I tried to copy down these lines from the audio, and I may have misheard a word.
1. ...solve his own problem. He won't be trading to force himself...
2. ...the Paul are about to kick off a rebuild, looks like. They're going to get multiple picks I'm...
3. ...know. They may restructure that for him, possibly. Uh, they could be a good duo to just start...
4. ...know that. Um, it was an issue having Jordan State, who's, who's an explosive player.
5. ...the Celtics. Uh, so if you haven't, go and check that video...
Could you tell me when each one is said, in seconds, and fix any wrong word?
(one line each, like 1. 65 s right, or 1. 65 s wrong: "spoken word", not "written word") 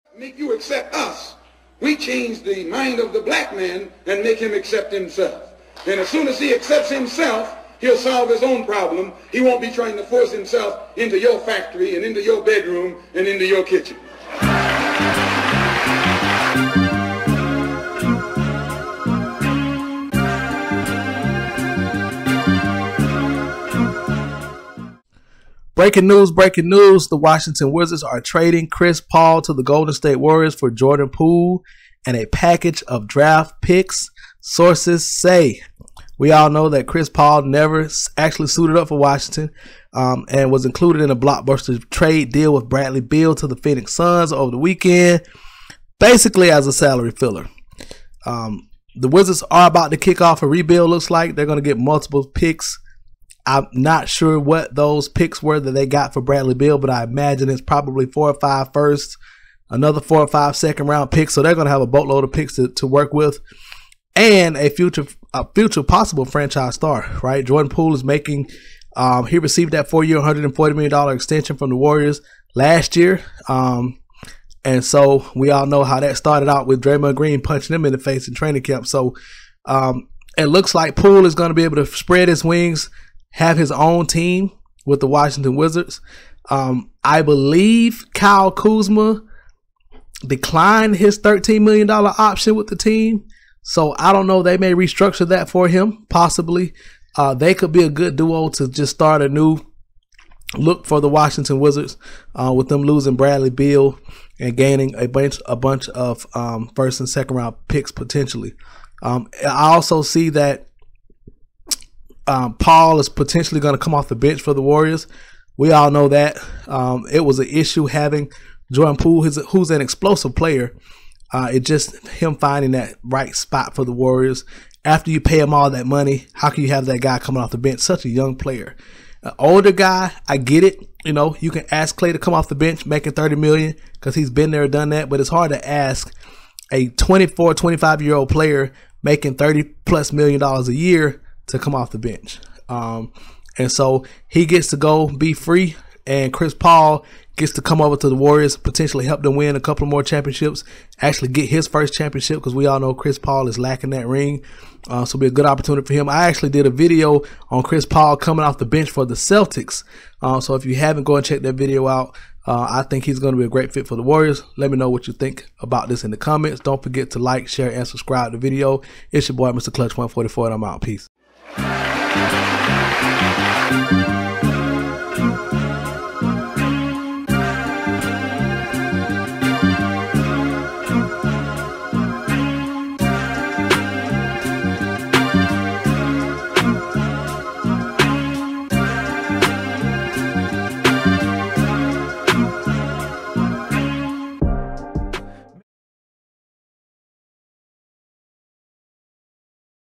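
1. 7 s wrong: "trying", not "trading"
2. 48 s wrong: "Wizards", not "Paul"
3. 94 s right
4. 115 s wrong: "Poole", not "State"
5. 159 s right.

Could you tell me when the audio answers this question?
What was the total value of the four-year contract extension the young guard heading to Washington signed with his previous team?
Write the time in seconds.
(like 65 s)
70 s.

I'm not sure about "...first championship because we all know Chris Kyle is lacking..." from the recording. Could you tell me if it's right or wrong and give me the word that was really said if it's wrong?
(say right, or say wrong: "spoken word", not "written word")
wrong: "Paul", not "Kyle".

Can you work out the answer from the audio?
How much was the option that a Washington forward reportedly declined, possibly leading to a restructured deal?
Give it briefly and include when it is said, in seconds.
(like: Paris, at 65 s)
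$13 million, at 91 s.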